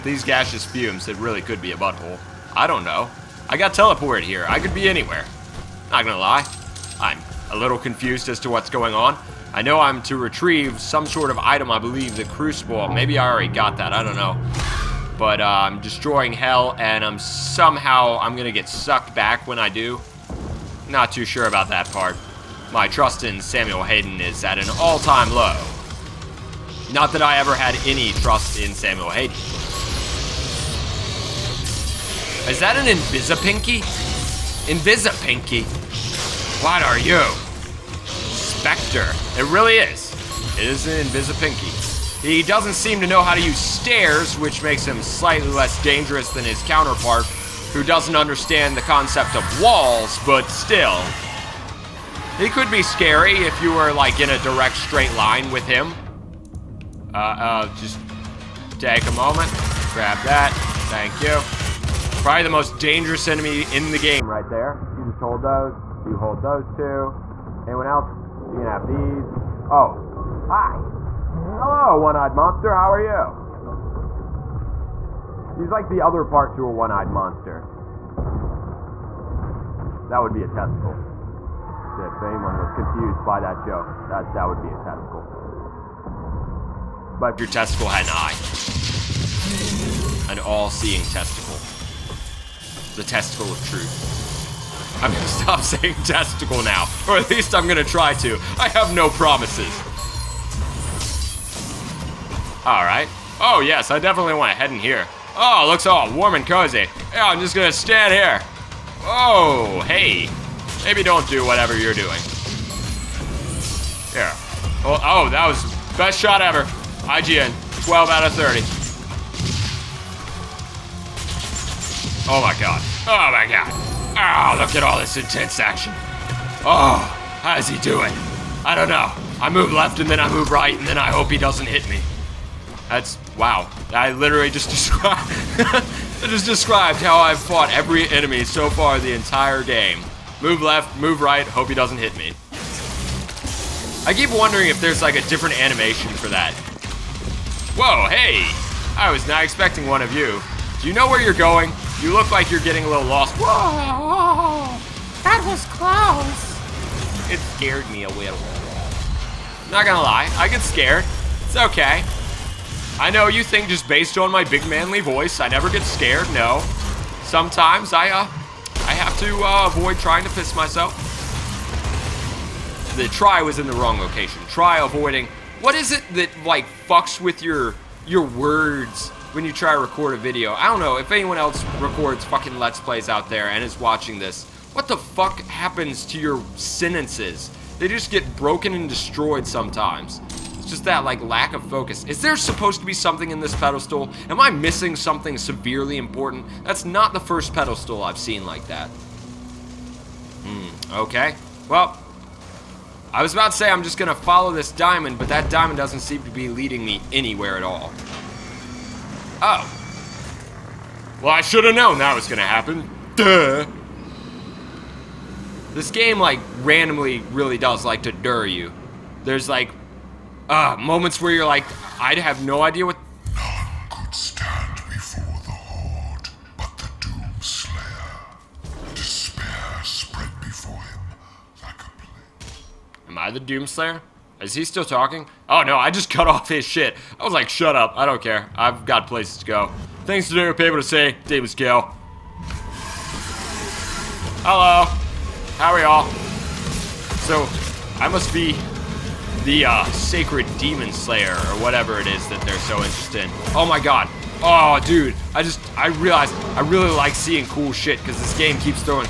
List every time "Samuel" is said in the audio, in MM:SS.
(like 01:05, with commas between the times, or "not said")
00:23, 00:28.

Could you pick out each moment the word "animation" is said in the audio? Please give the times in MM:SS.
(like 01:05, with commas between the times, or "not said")
02:25.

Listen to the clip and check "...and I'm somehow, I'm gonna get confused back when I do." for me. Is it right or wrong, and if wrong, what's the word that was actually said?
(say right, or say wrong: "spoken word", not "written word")
wrong: "sucked", not "confused".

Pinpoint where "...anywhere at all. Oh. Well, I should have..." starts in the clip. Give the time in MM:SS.
03:27.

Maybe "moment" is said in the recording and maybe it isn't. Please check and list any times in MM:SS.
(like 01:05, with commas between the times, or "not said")
00:59, 03:40.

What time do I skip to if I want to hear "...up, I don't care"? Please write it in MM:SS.
03:57.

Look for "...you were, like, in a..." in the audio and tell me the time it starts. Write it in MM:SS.
00:53.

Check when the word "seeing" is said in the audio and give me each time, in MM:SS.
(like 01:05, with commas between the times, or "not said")
01:30, 04:17.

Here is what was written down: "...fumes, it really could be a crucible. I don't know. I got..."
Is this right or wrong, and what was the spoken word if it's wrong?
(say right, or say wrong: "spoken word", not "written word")
wrong: "butthole", not "crucible".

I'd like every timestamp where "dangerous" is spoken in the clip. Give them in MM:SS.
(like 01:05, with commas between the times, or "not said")
00:45, 01:02.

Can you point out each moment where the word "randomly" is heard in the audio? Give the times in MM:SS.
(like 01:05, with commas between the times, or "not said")
03:36.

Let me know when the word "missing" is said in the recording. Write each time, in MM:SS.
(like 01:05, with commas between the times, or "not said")
03:14.